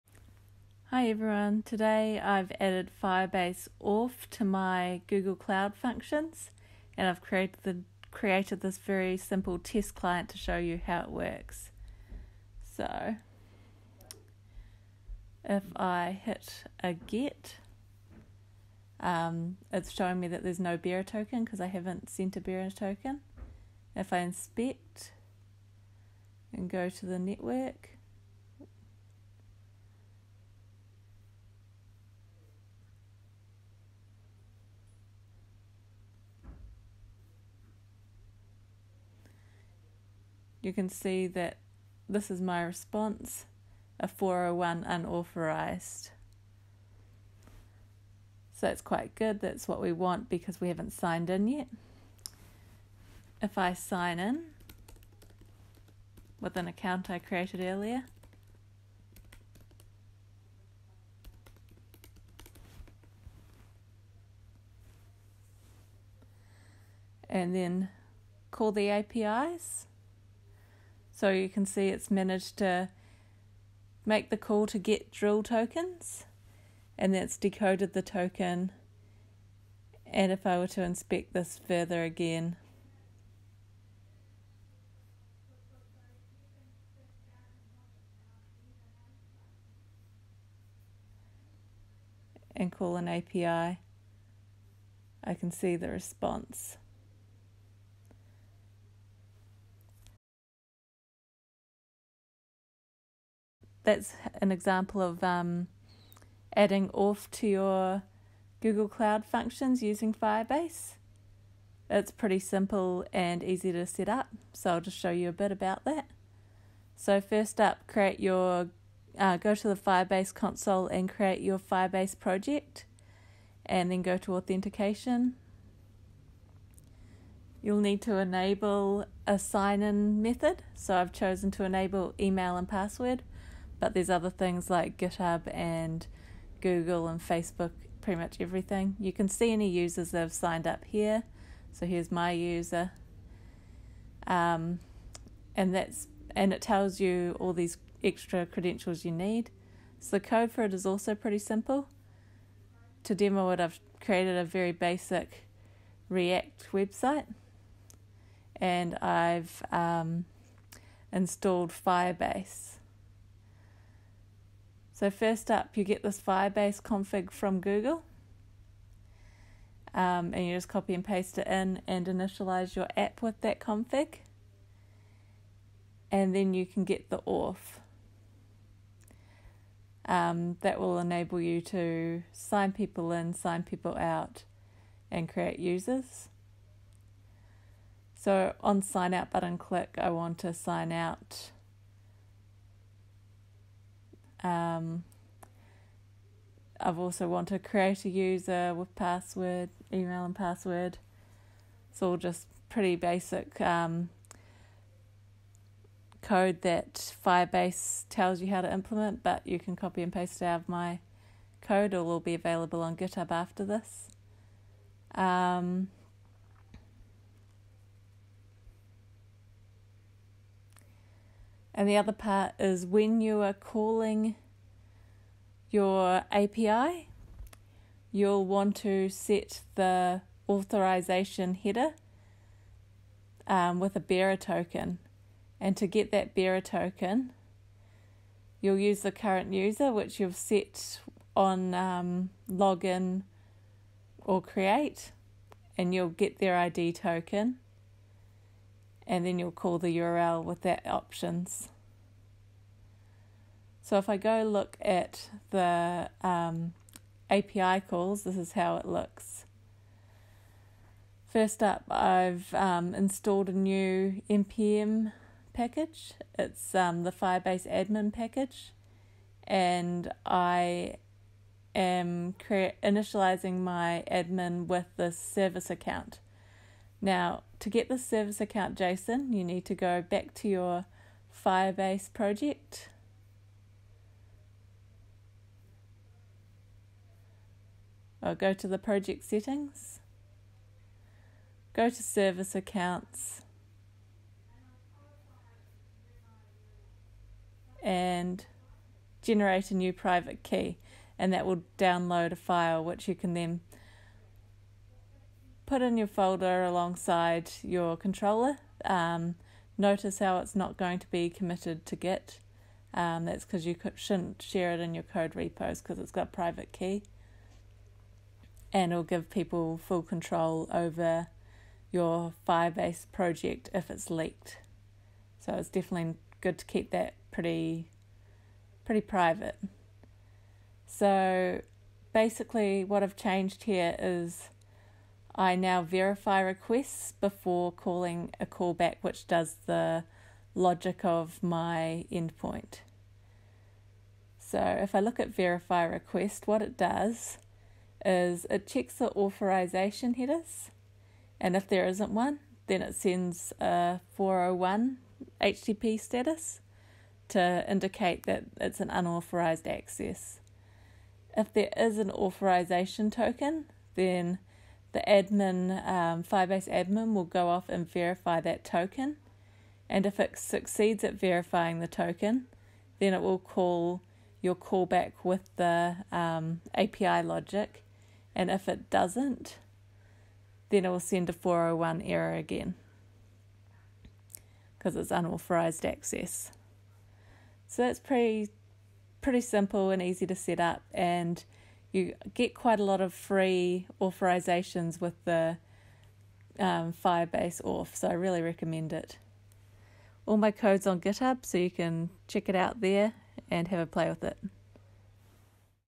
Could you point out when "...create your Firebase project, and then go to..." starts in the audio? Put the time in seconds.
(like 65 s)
121 s.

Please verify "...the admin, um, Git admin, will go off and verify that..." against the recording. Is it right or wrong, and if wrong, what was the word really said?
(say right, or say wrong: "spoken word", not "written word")
wrong: "Firebase", not "Git".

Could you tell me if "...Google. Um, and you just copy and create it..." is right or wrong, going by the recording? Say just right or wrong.
wrong.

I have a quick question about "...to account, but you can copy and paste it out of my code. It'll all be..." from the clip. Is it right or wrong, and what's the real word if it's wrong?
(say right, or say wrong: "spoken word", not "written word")
wrong: "implement", not "account".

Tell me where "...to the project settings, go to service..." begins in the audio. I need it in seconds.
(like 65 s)
288 s.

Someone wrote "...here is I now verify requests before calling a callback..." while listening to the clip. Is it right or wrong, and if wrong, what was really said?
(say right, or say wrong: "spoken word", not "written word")
right.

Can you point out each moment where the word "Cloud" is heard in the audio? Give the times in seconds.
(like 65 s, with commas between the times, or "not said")
5 s, 108 s.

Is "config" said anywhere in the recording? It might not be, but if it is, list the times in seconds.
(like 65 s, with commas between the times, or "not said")
166 s, 173 s.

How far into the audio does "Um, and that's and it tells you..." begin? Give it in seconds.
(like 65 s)
144 s.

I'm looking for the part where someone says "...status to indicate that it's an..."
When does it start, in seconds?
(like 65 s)
355 s.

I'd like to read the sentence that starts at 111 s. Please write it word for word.
It's pretty simple and easy to set up, so I'll just show you a bit about that.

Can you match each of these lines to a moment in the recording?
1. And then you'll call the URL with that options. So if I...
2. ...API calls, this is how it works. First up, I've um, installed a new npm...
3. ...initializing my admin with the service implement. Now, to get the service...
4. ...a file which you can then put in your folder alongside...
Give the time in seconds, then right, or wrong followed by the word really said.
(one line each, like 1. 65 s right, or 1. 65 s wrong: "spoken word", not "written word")
1. 249 s right
2. 257 s wrong: "looks", not "works"
3. 272 s wrong: "account", not "implement"
4. 302 s right.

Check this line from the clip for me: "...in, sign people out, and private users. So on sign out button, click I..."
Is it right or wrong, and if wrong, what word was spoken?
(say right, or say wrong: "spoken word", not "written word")
wrong: "create", not "private".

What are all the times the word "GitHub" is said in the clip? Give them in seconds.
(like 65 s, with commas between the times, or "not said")
134 s, 212 s, 401 s.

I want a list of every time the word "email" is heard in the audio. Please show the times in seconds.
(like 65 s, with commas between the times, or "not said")
132 s, 199 s.